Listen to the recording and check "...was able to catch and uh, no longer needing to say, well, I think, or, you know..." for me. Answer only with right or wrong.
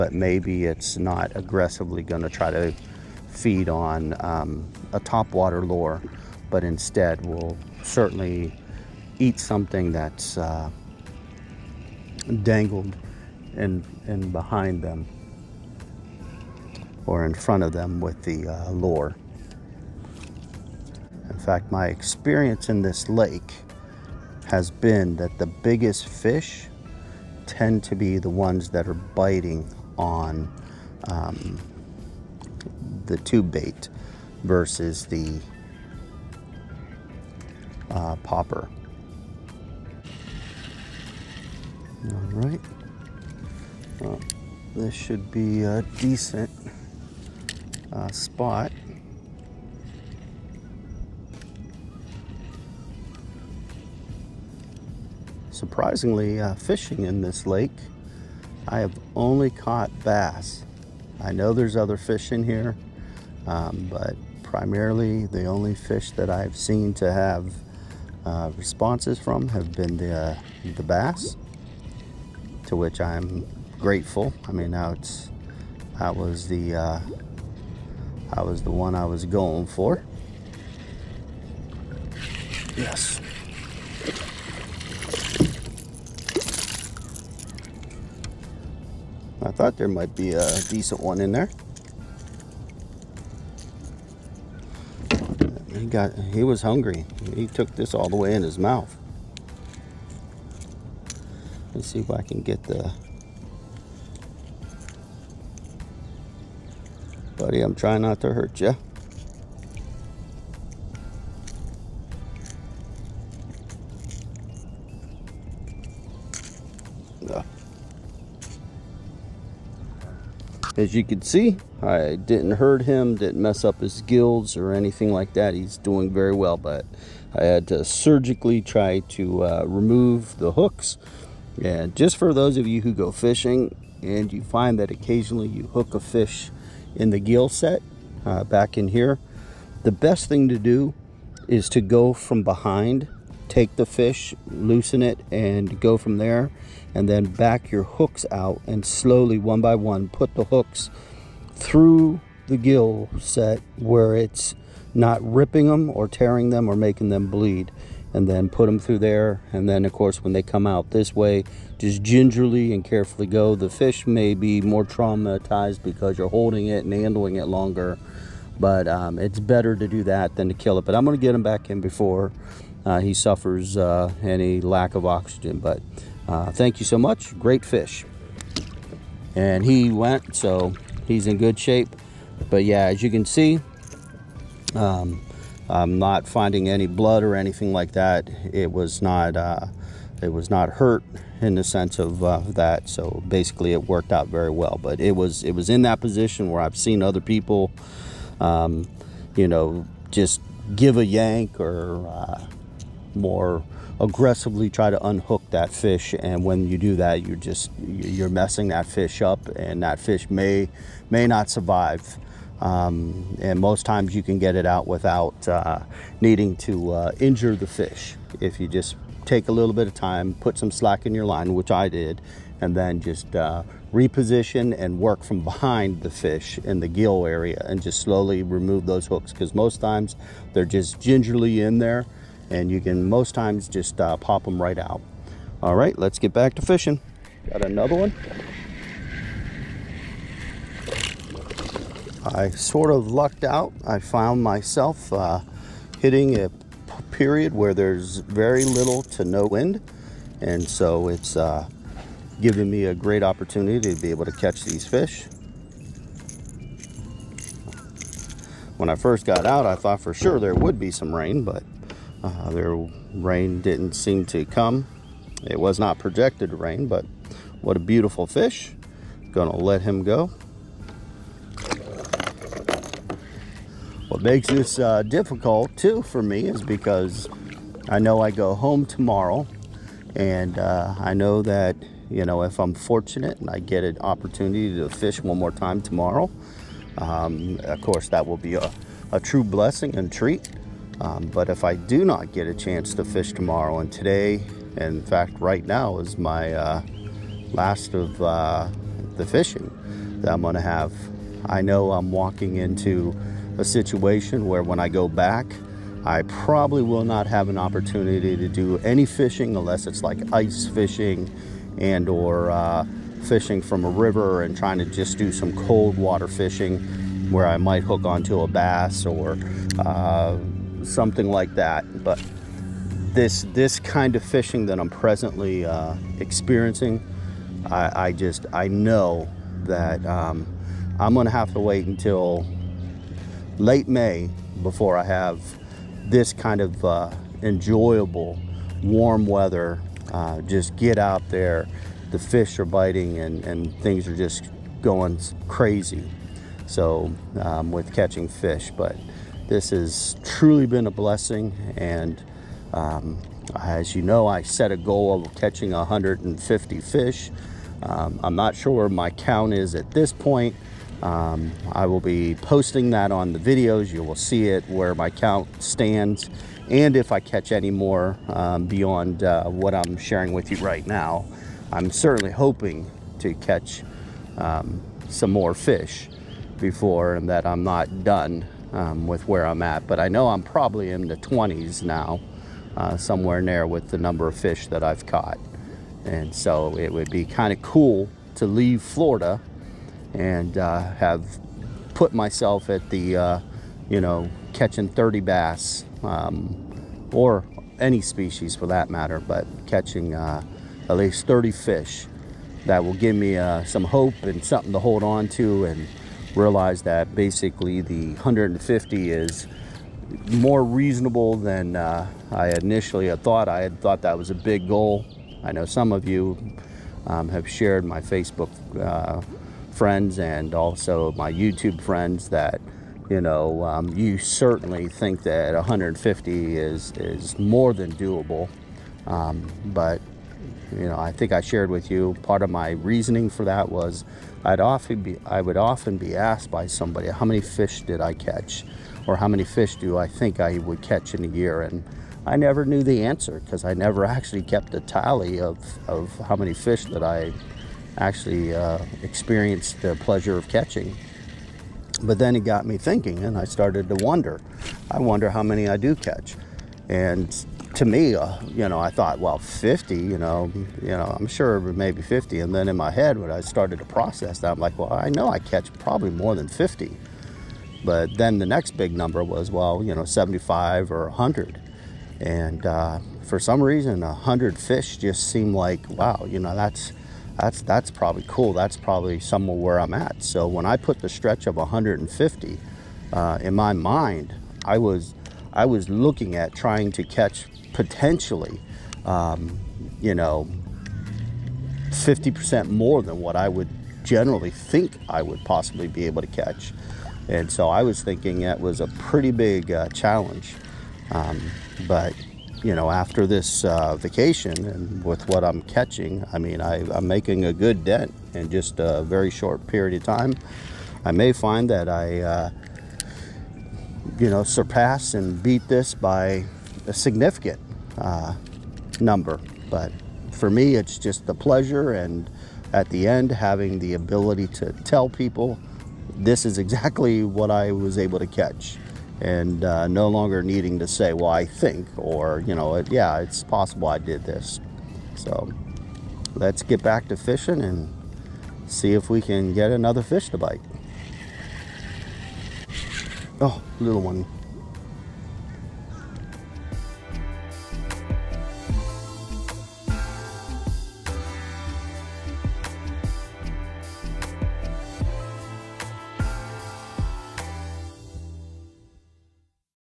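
right.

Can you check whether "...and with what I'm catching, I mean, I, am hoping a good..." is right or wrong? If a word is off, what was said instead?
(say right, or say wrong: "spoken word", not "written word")
wrong: "making", not "hoping".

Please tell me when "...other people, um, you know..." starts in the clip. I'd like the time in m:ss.
3:17.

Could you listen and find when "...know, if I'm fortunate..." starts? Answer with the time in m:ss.
4:42.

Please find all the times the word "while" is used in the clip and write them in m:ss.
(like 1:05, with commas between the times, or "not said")
not said.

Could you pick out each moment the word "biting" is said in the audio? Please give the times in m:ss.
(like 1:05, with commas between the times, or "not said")
0:28, 5:42.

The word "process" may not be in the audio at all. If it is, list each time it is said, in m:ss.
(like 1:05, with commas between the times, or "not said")
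7:43.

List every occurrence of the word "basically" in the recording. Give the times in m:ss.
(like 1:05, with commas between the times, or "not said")
3:13, 6:47.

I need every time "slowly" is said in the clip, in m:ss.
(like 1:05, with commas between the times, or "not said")
2:28, 3:47.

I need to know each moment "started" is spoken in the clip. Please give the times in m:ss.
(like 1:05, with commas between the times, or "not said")
7:33, 7:43.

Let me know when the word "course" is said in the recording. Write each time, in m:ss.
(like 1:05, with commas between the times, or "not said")
2:39, 4:47.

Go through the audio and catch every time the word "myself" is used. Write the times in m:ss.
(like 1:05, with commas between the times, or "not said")
4:04, 6:32.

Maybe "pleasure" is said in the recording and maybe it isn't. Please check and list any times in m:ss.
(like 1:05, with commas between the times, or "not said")
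7:29, 8:41.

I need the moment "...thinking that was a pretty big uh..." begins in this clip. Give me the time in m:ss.
8:18.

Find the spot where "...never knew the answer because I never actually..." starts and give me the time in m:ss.
7:22.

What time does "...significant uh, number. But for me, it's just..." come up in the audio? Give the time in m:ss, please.
8:36.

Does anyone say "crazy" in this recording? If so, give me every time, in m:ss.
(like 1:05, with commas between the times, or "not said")
5:45.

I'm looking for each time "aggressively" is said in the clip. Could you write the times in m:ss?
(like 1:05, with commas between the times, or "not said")
0:01, 3:23.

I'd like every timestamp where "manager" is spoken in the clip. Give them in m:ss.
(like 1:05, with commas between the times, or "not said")
not said.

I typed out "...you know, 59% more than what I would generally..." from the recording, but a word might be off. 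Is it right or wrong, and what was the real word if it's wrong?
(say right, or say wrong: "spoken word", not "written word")
wrong: "50", not "59".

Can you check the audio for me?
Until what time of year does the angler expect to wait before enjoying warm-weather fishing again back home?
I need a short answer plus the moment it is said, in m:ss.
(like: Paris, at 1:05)
late May, at 5:33.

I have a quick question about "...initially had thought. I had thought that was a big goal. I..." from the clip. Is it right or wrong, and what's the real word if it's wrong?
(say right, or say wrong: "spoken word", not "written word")
right.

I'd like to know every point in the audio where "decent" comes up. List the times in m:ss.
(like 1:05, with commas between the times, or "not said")
0:45, 1:30.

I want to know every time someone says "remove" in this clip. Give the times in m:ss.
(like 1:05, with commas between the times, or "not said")
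2:09, 3:48.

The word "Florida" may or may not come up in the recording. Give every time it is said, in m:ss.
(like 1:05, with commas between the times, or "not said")
6:28.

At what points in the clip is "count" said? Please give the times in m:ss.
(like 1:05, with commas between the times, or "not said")
5:59, 6:05.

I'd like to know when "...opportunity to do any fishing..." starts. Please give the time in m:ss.
5:07.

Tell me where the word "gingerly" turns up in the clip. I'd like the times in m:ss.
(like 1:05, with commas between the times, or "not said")
2:42, 3:50.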